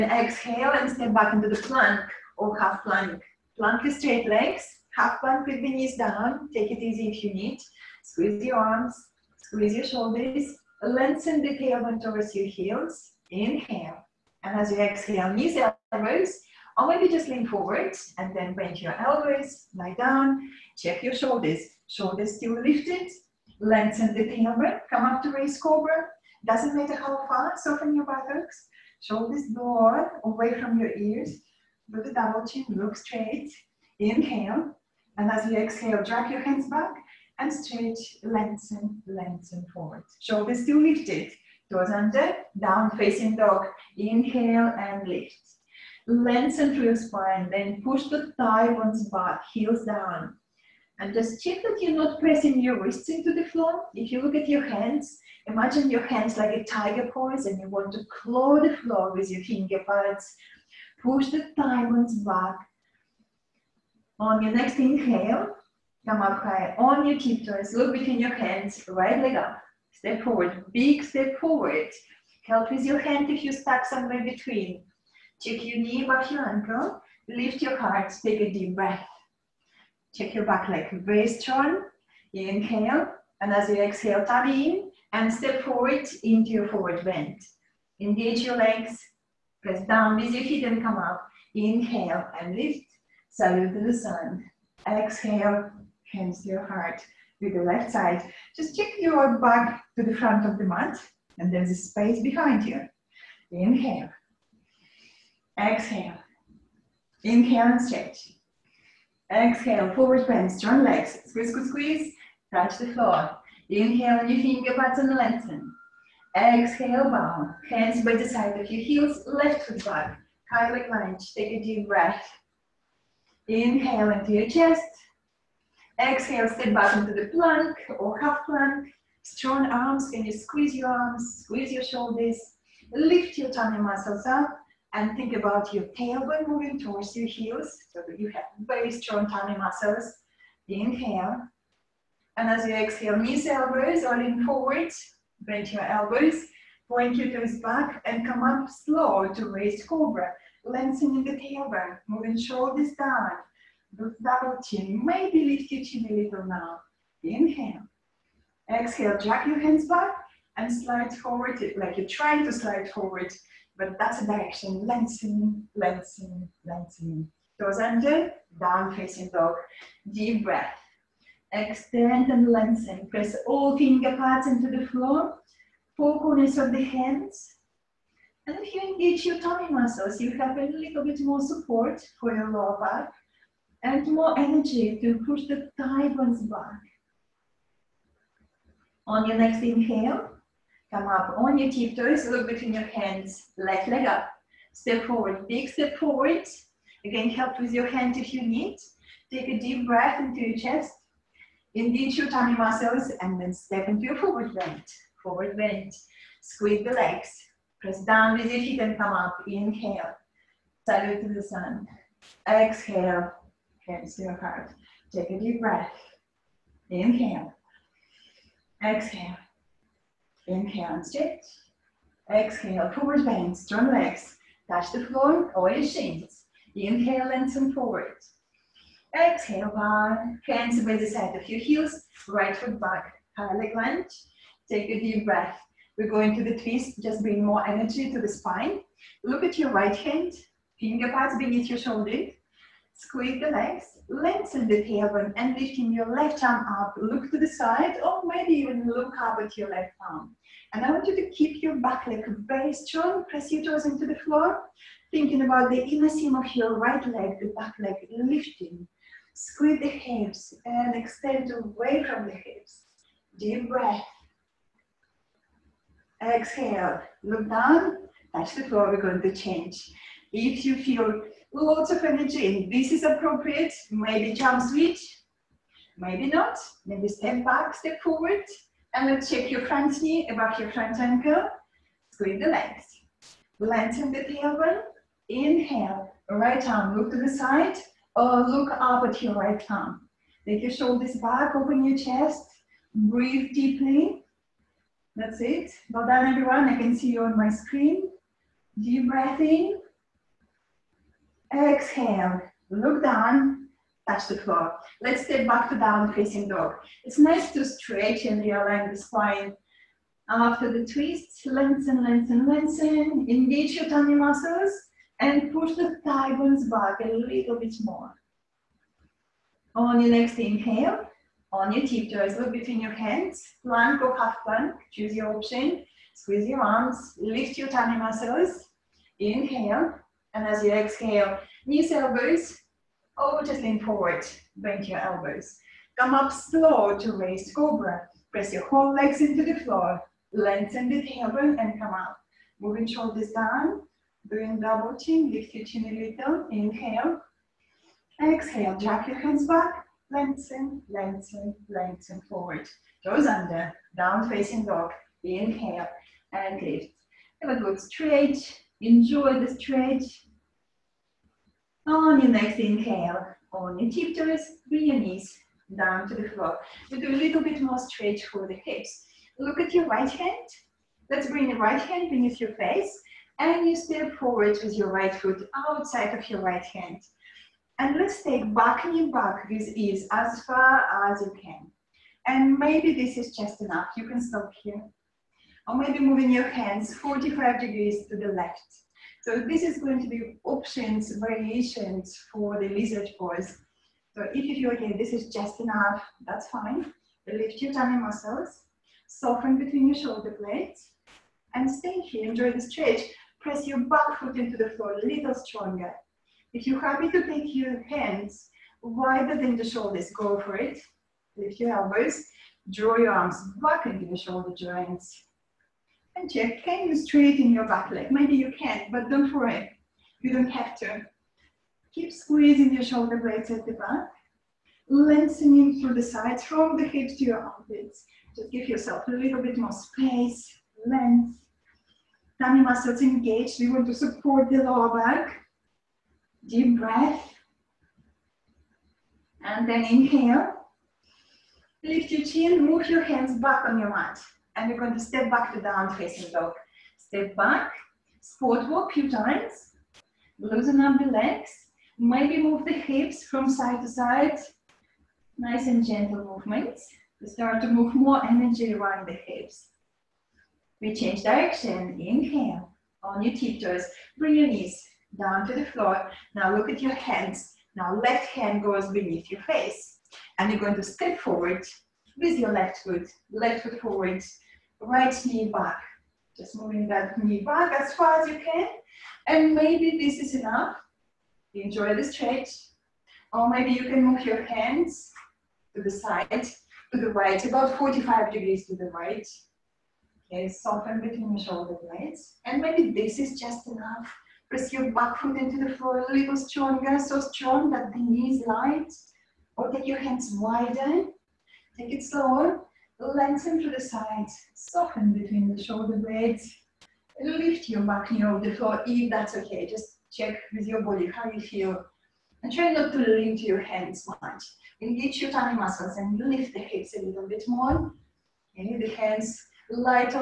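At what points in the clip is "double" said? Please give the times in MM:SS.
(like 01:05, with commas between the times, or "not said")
00:32, 02:33, 05:44.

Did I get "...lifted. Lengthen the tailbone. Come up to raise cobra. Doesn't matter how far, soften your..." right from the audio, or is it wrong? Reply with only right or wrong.
right.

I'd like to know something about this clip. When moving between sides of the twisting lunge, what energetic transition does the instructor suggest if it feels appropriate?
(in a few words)
jump switch.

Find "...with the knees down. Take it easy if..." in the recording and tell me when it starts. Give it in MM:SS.
00:05.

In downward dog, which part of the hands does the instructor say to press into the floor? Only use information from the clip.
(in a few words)
four corners of the hands.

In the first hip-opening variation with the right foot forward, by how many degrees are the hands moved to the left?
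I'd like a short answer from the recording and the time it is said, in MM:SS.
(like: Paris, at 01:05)
45, at 06:26.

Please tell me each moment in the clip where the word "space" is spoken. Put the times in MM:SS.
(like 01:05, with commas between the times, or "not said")
01:41, 07:09.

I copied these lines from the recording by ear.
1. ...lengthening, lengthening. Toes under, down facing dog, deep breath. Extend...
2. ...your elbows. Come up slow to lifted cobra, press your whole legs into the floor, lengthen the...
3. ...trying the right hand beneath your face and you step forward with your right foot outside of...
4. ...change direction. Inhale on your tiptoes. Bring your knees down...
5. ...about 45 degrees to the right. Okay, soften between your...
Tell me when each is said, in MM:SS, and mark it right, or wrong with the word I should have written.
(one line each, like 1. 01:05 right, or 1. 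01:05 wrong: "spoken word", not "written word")
1. 02:45 right
2. 05:34 wrong: "raised", not "lifted"
3. 06:11 wrong: "bring", not "trying"
4. 07:40 right
5. 08:07 right.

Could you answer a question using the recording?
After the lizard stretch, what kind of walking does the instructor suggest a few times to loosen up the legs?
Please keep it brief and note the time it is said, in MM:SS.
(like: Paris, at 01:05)
squat walk, at 07:28.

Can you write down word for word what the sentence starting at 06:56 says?
And check, can you straighten your back leg?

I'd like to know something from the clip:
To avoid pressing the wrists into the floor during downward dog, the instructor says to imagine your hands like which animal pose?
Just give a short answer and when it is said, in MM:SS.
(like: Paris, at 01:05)
tiger pose, at 00:56.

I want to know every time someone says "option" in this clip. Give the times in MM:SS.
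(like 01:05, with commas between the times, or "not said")
05:25, 06:30.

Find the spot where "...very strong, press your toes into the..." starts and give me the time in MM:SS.
04:12.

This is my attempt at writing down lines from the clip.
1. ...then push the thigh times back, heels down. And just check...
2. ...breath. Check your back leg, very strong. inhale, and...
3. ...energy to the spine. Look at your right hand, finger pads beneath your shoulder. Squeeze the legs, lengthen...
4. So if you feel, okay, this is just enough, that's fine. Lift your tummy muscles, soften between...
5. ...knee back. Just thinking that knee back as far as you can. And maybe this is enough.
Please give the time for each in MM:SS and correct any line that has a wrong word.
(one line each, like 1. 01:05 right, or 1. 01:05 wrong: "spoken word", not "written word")
1. 00:47 wrong: "bones", not "times"
2. 01:18 right
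3. 03:57 right
4. 06:34 right
5. 07:55 wrong: "moving", not "thinking".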